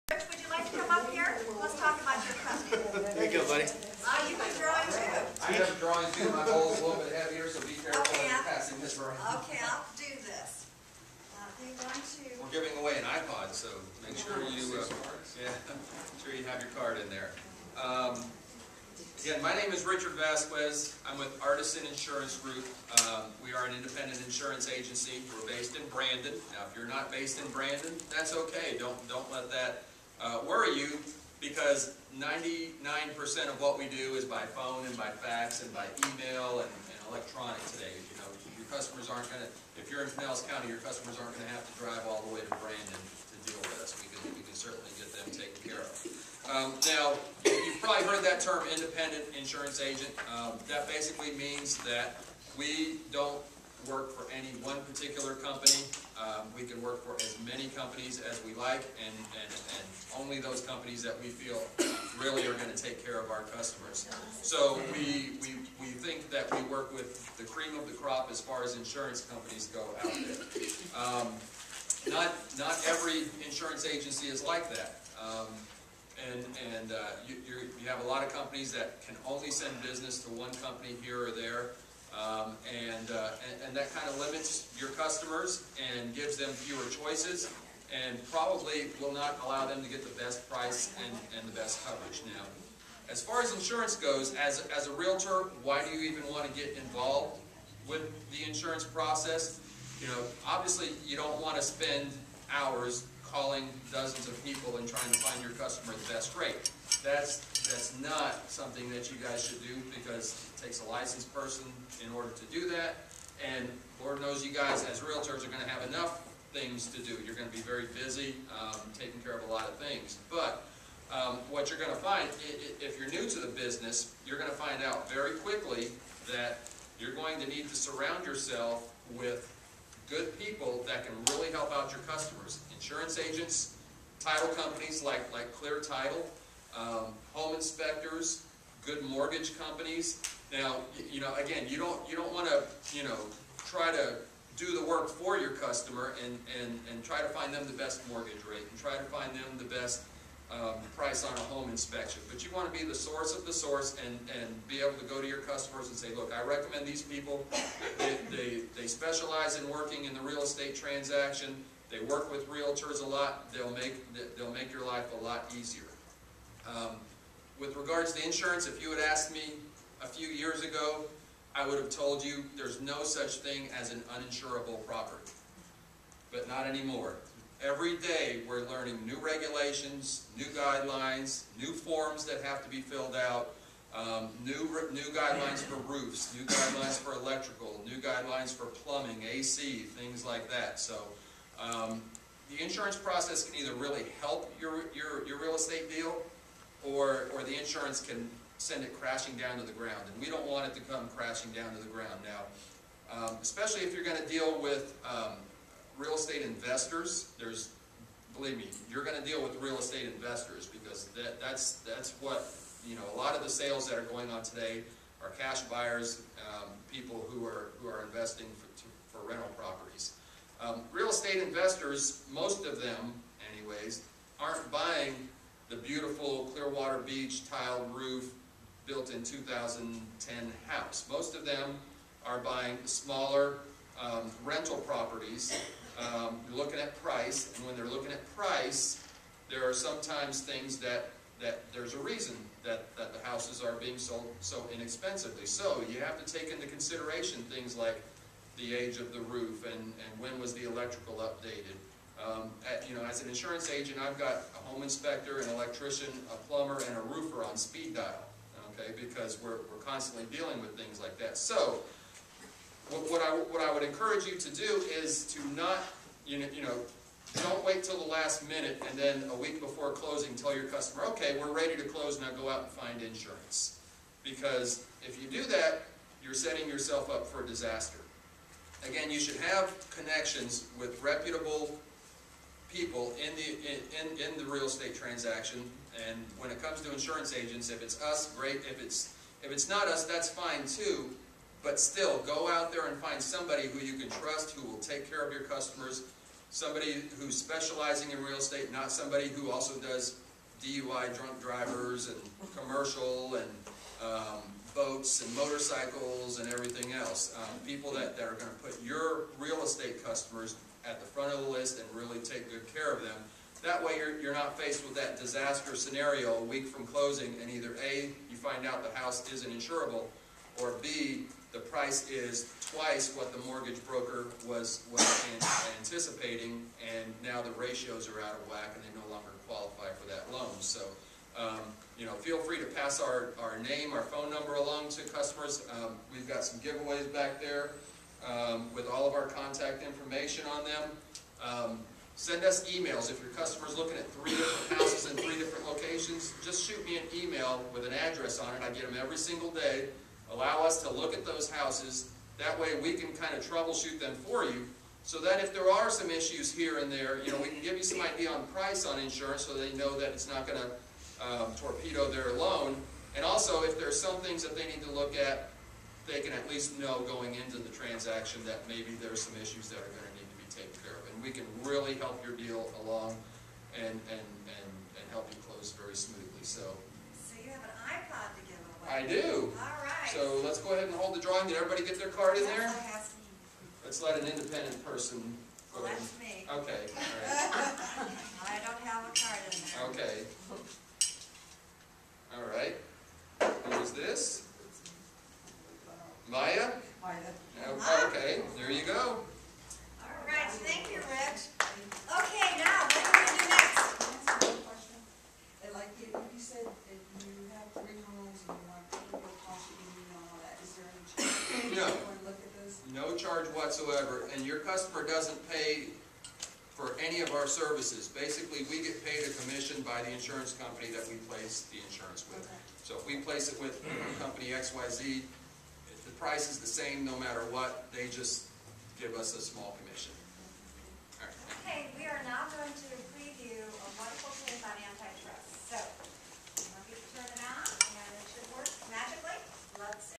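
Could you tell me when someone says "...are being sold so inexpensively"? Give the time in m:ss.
4:03.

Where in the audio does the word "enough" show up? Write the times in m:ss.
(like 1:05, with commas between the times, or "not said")
1:55.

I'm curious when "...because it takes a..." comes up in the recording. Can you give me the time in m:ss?
1:49.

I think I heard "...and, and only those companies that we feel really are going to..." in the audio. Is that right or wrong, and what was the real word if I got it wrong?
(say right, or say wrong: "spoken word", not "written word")
right.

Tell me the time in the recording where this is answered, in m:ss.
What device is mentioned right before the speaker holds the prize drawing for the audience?
6:17.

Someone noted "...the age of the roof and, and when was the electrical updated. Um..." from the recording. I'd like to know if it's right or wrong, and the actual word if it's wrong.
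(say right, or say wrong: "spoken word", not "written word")
right.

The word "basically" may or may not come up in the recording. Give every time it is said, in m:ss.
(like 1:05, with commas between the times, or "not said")
0:50, 6:58.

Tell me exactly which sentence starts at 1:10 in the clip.
Um, not, not every insurance agency is like that.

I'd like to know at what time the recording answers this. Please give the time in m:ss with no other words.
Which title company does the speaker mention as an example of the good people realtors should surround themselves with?
2:15.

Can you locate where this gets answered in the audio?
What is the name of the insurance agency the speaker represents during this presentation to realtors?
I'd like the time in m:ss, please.
0:21.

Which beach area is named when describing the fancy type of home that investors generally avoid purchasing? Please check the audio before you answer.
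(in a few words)
Clearwater Beach.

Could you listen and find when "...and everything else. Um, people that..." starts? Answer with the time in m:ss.
5:06.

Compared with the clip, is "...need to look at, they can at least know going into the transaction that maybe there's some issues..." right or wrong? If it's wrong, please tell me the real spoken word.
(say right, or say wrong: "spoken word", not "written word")
right.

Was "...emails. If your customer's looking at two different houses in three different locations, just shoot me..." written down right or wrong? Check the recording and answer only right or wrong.
wrong.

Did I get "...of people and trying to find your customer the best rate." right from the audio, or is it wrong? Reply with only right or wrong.
right.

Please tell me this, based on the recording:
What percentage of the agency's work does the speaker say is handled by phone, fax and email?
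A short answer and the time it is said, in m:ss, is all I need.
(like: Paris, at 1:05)
99%, at 0:32.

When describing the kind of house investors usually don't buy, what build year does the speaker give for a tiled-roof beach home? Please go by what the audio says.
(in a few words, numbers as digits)
2010.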